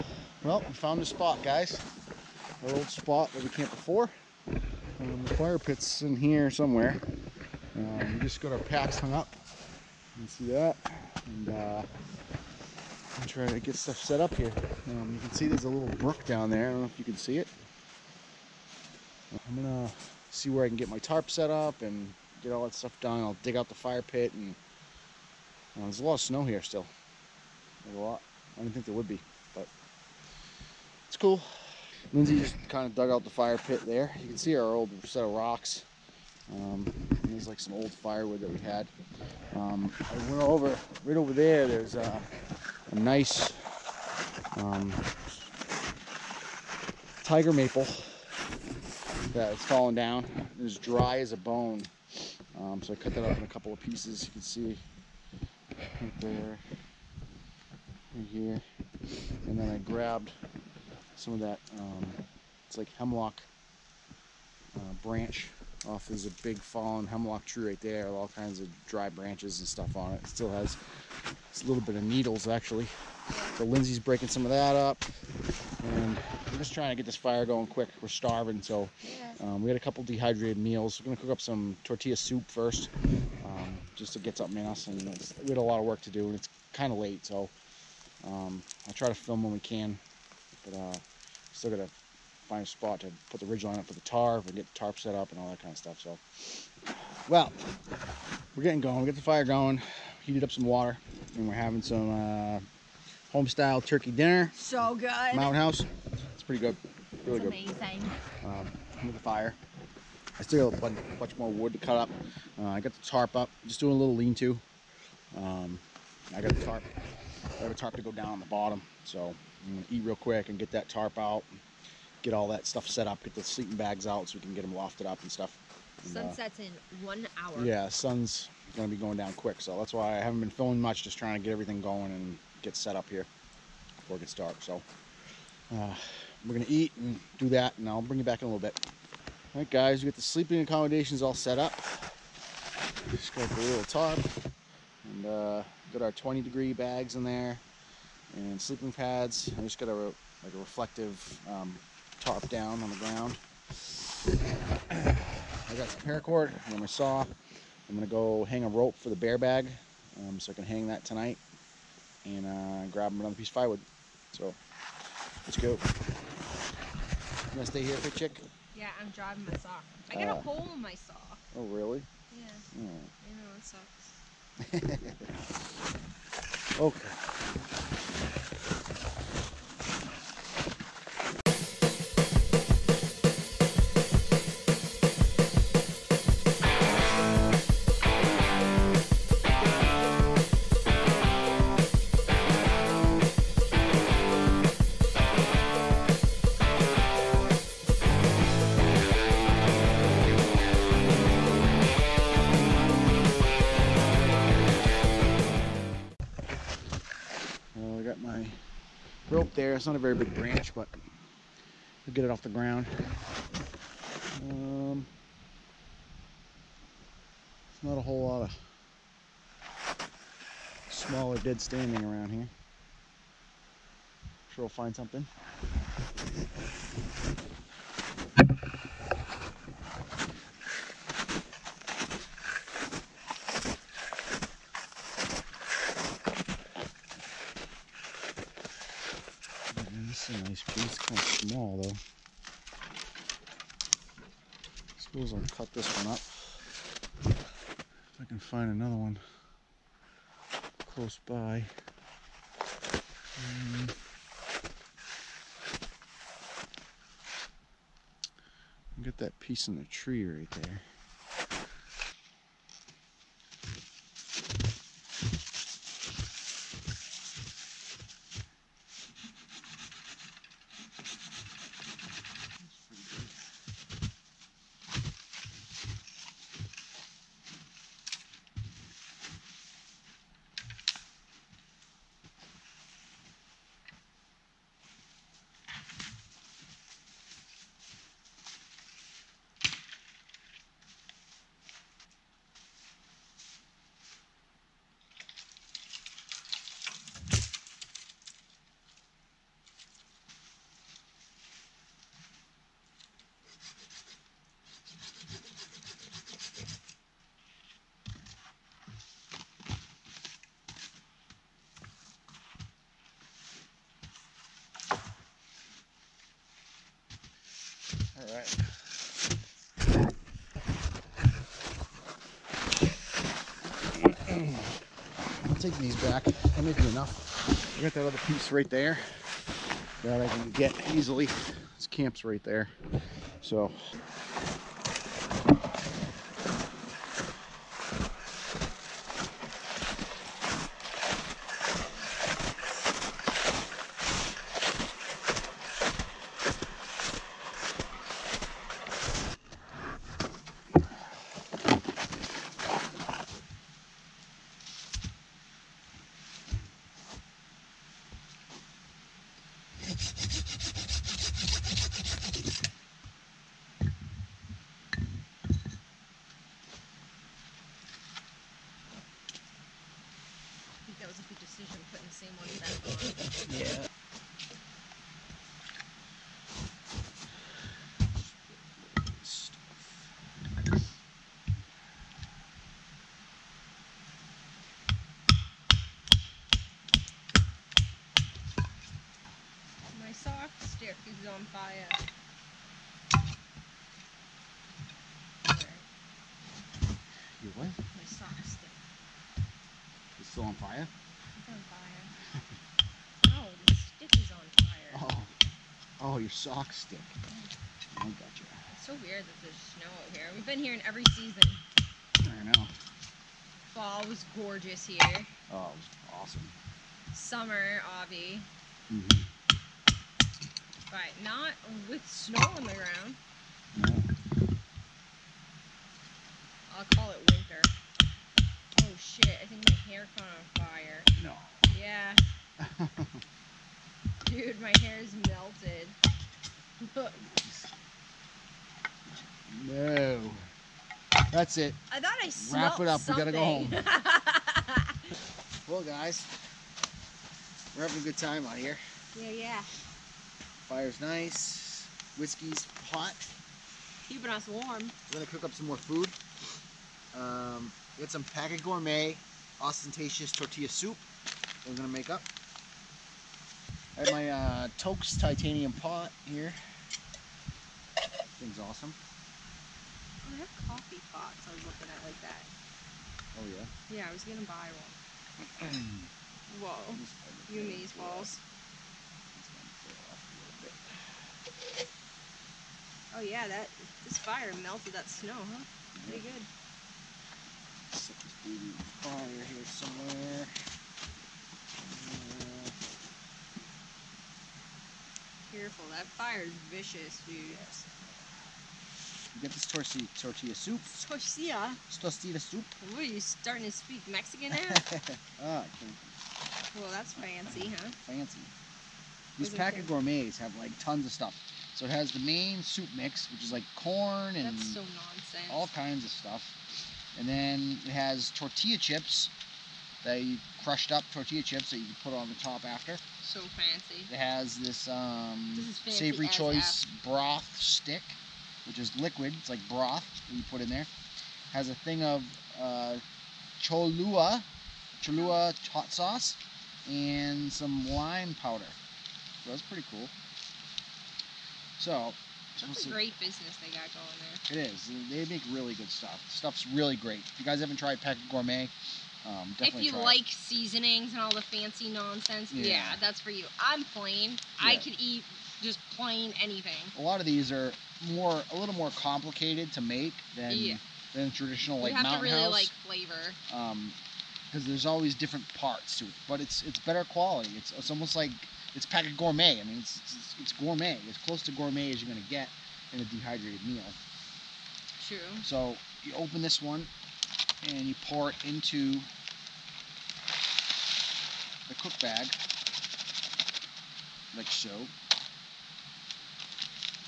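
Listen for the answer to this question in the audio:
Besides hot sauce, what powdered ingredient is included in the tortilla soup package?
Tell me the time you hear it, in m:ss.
8:57.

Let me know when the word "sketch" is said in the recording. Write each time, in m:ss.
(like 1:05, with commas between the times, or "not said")
not said.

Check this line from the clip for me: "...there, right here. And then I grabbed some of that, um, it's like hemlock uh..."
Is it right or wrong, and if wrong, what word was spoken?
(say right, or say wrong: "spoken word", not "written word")
right.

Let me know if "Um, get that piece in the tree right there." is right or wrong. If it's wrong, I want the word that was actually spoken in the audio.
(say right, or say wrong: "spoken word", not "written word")
right.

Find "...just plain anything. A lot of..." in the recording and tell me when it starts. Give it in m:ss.
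9:15.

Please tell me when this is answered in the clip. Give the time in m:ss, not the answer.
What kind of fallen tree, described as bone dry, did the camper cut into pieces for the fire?
0:47.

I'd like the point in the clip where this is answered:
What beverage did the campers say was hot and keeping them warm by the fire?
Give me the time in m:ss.
7:32.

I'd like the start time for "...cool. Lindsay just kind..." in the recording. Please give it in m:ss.
0:31.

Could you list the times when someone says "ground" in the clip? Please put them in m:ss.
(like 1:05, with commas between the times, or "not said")
2:32, 3:32, 7:02.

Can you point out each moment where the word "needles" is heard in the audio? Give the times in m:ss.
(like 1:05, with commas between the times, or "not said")
1:12.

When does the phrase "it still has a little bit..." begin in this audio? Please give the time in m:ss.
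1:10.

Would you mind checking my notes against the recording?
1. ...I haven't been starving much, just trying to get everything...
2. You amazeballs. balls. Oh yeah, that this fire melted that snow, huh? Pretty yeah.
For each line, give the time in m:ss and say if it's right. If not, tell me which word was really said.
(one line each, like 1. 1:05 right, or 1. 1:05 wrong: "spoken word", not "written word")
1. 2:10 wrong: "filming", not "starving"
2. 7:57 right.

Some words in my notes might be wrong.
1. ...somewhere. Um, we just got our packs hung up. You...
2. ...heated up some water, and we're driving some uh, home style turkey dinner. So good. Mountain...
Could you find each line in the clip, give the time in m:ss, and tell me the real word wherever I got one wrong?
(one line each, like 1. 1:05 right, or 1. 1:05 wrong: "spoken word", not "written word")
1. 0:06 right
2. 1:40 wrong: "having", not "driving".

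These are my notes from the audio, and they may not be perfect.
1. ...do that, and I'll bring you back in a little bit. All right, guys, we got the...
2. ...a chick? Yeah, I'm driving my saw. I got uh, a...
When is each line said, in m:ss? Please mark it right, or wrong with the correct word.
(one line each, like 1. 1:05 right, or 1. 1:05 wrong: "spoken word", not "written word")
1. 2:17 right
2. 2:48 right.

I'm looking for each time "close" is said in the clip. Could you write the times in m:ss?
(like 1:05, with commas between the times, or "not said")
4:10, 9:31.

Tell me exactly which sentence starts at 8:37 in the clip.
And then it has tortilla chips, they crushed up tortilla chips that you can put on the top after.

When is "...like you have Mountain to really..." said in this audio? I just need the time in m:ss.
9:21.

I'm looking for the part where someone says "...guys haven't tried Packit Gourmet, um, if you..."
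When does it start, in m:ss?
9:07.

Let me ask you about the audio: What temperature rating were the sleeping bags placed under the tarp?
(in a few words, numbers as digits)
20 degree.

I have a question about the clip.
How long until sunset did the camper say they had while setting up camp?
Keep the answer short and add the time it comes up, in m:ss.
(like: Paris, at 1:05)
1 hour, at 2:07.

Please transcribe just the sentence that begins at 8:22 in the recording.
you are you starting to speak Mexican now?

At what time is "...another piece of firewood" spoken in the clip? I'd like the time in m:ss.
2:43.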